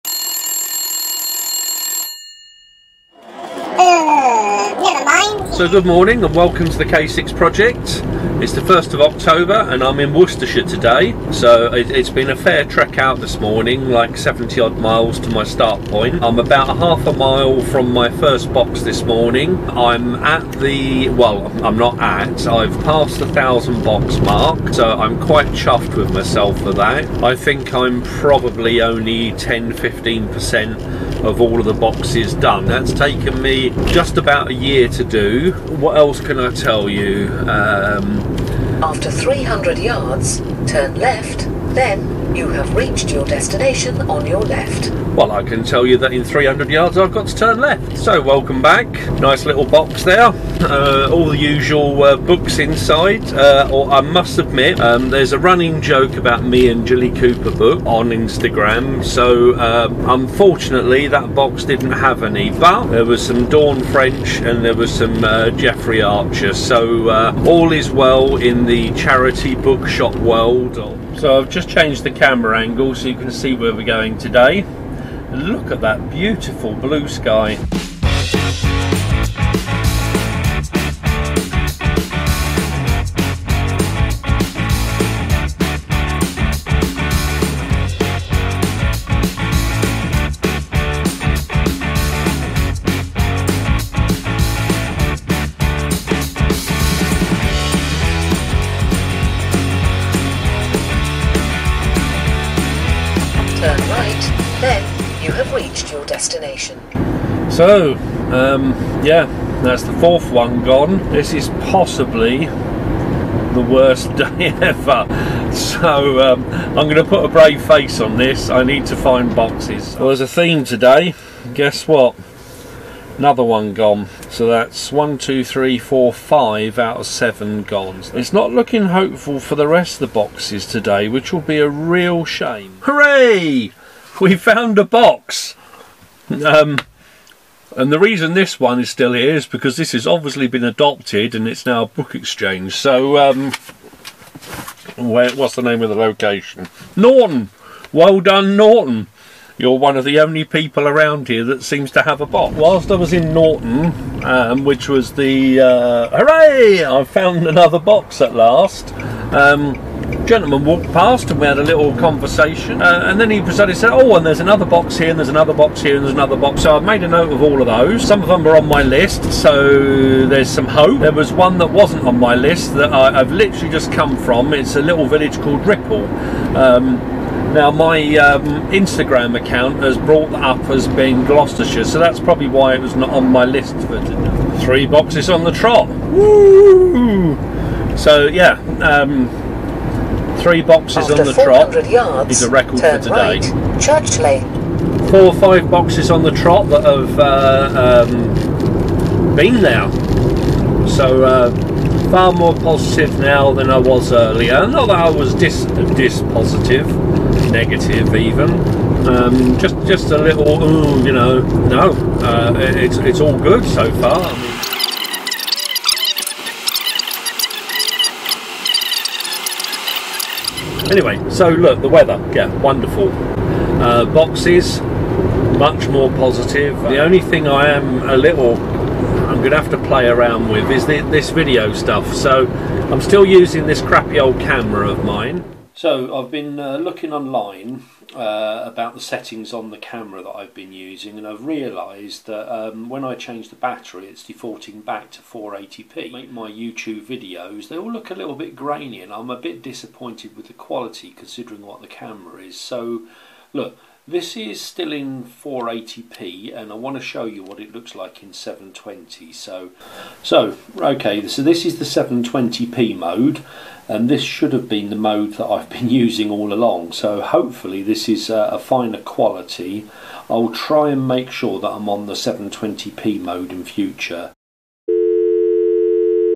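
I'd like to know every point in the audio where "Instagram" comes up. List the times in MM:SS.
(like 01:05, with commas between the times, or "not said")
00:58, 02:58.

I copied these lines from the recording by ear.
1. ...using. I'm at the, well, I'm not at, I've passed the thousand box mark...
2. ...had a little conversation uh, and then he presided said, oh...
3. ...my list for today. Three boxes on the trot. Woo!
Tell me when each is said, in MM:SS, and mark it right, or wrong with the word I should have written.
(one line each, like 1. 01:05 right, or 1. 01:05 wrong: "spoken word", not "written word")
1. 00:19 wrong: "morning", not "using"
2. 02:41 right
3. 03:03 right.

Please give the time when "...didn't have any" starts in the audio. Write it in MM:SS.
01:01.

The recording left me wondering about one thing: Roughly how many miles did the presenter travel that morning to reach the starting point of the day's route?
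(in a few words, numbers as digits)
70.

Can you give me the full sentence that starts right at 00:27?
I think I'm probably only 10 15% of all of the boxes done.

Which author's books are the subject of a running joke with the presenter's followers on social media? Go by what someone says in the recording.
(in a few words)
Jilly Cooper.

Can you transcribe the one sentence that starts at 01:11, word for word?
So, I've just changed the camera angle so you can see where we're going today.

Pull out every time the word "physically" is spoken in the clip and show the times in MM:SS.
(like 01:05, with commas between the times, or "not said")
not said.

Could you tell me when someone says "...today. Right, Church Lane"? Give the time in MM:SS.
03:12.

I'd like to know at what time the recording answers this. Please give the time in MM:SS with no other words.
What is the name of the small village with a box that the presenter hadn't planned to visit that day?
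02:55.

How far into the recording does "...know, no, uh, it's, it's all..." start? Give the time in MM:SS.
03:31.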